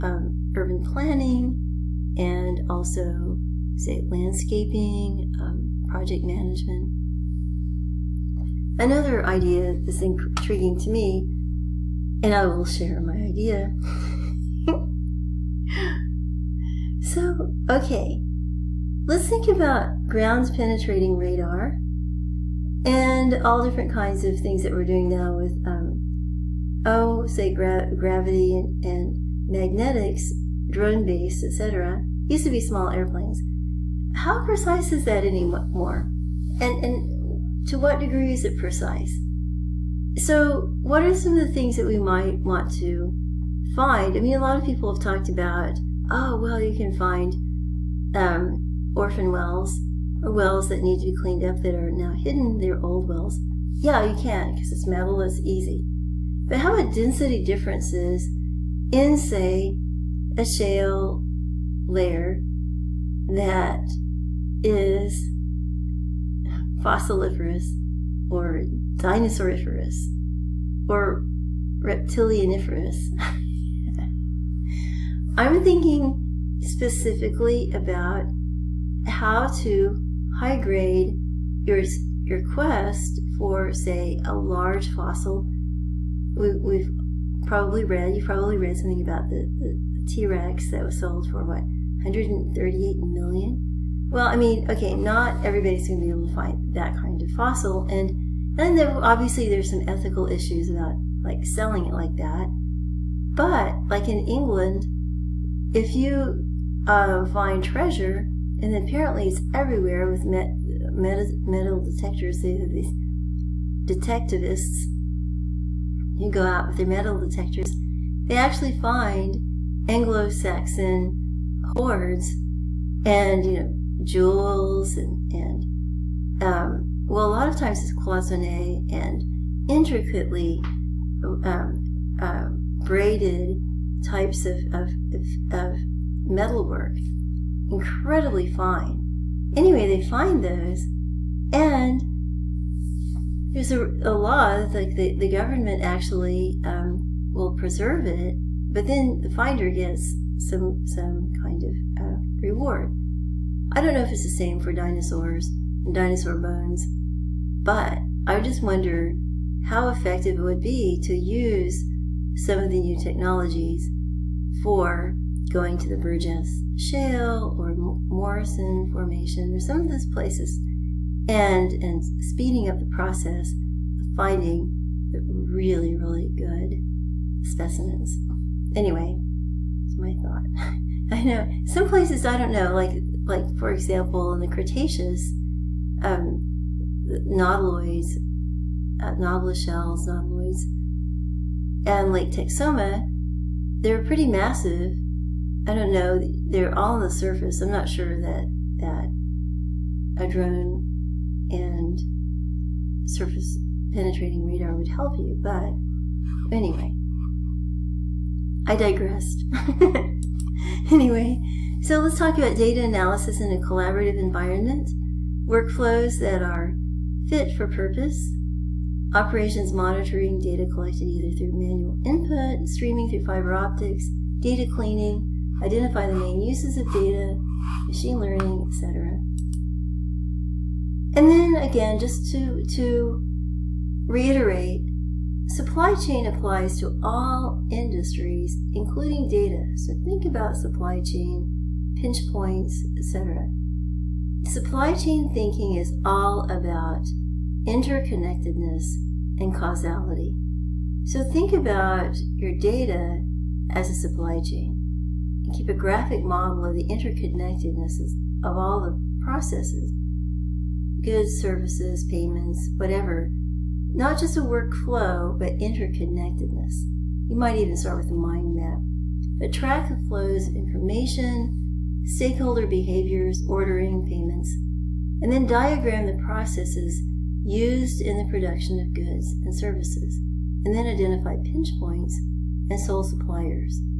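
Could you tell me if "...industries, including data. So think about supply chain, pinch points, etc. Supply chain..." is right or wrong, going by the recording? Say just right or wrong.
right.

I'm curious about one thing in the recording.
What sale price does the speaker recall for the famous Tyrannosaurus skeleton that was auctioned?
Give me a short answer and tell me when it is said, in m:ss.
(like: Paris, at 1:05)
138 million, at 1:32.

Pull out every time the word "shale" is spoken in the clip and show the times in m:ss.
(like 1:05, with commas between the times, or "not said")
1:00, 2:46.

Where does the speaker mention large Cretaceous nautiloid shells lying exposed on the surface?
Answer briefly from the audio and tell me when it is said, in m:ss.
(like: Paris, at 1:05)
Lake Texoma, at 3:12.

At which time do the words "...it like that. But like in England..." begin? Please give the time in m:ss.
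1:41.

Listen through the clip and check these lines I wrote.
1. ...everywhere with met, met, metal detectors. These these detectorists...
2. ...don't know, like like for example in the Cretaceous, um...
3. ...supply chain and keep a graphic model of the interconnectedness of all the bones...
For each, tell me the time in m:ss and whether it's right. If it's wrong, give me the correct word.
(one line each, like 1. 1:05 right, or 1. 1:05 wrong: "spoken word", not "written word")
1. 1:49 right
2. 3:02 right
3. 4:13 wrong: "processes", not "bones".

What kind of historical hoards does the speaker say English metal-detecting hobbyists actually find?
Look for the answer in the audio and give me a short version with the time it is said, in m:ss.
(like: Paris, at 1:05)
Anglo-Saxon, at 1:59.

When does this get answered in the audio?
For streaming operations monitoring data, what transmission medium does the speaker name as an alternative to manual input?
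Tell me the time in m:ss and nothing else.
3:43.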